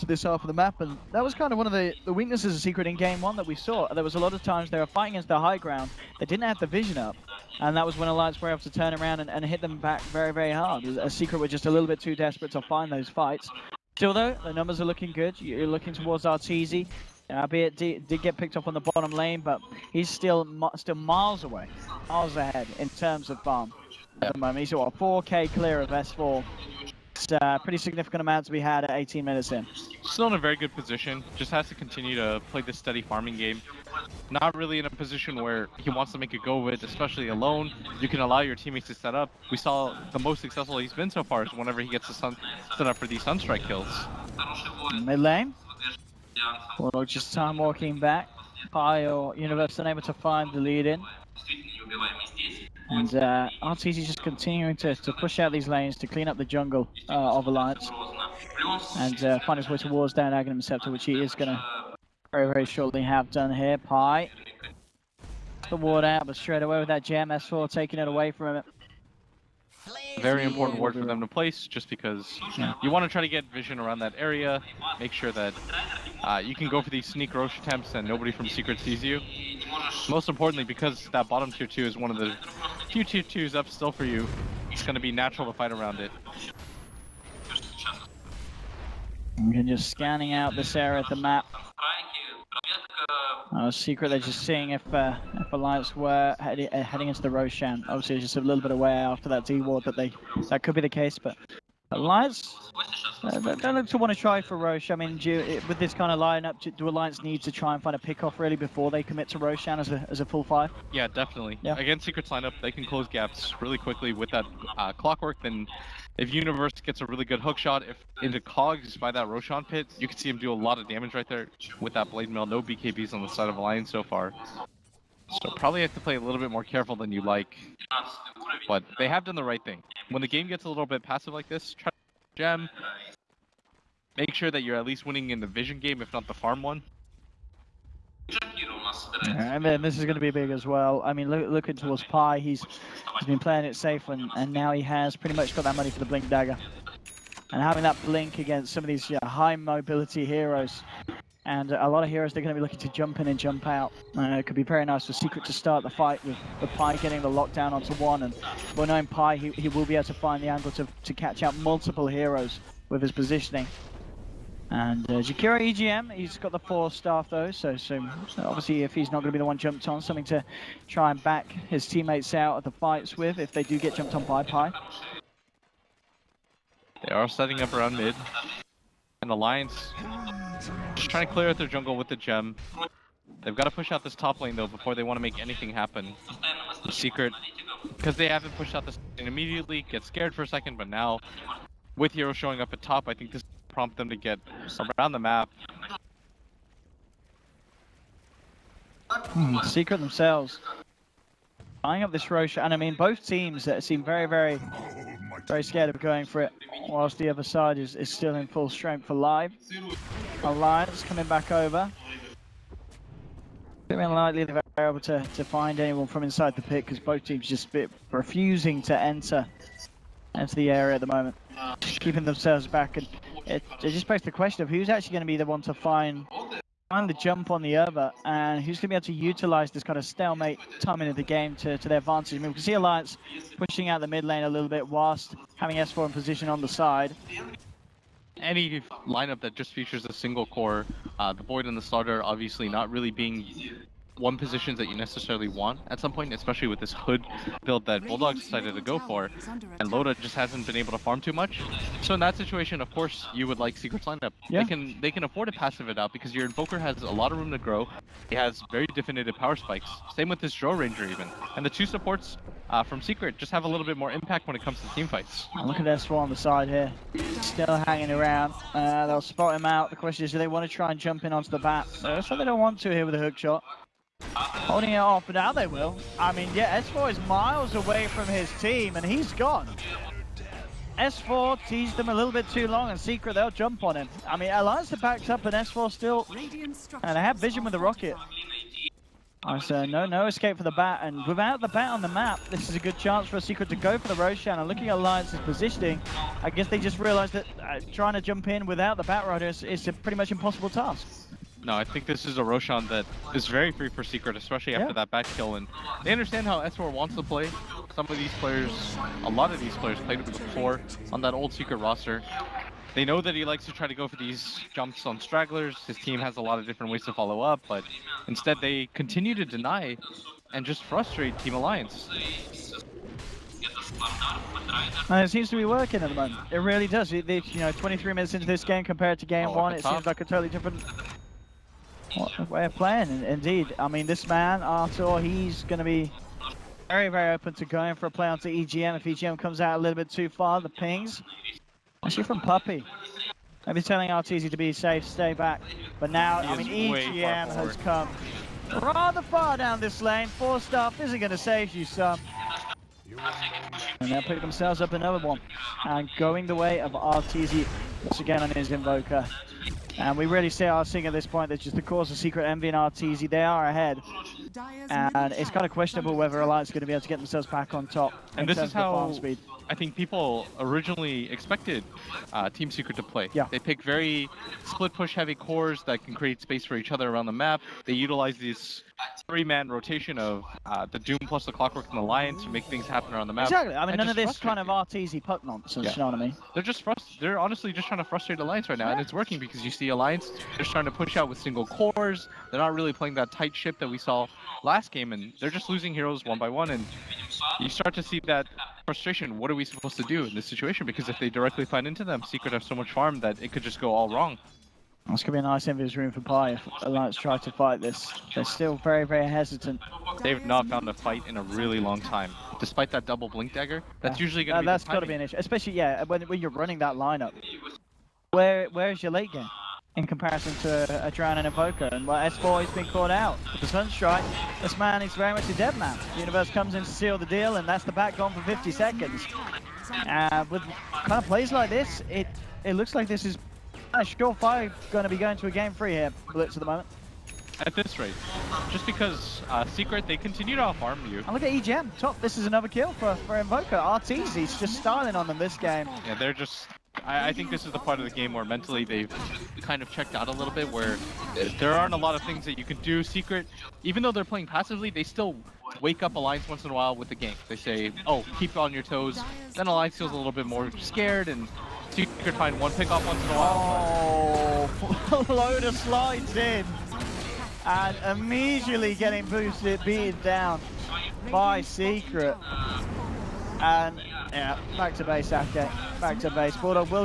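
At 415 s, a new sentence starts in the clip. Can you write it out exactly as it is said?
Especially, yeah, when, when you're running that lineup.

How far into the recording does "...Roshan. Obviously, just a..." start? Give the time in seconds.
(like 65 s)
97 s.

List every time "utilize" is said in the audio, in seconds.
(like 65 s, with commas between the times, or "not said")
229 s, 377 s.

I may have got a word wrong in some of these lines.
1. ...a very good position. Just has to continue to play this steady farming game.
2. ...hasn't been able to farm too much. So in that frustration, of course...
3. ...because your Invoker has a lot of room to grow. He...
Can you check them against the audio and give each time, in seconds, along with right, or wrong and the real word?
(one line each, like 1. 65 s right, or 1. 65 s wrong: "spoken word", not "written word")
1. 30 s right
2. 250 s wrong: "situation", not "frustration"
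3. 256 s right.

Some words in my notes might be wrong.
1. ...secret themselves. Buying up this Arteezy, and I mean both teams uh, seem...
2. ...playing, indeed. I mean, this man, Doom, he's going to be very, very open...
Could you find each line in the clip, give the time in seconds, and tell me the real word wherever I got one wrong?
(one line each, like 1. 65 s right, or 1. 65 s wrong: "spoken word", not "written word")
1. 199 s wrong: "Rosh", not "Arteezy"
2. 332 s wrong: "Artur", not "Doom".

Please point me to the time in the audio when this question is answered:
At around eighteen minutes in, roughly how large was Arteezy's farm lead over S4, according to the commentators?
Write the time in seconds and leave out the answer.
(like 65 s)
24 s.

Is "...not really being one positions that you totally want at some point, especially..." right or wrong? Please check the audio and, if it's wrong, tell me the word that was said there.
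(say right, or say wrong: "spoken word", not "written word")
wrong: "necessarily", not "totally".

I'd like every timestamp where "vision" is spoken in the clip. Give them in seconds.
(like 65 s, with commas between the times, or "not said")
6 s, 73 s, 135 s, 287 s.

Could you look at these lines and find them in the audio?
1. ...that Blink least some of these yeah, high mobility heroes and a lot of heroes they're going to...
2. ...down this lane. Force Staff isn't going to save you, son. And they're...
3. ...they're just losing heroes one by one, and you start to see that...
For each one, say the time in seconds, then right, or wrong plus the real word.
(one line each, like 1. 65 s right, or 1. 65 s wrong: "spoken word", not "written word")
1. 147 s wrong: "against", not "least"
2. 349 s right
3. 395 s right.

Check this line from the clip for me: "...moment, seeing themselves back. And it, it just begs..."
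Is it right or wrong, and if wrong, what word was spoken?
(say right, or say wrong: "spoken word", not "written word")
wrong: "keeping", not "seeing".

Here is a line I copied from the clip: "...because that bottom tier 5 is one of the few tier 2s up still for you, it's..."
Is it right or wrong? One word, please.
wrong.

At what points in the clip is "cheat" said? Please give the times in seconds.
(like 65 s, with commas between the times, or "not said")
not said.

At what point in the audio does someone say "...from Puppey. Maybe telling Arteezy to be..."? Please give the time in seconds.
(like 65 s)
342 s.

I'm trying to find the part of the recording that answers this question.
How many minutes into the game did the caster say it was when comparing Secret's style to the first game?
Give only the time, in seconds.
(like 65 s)
327 s.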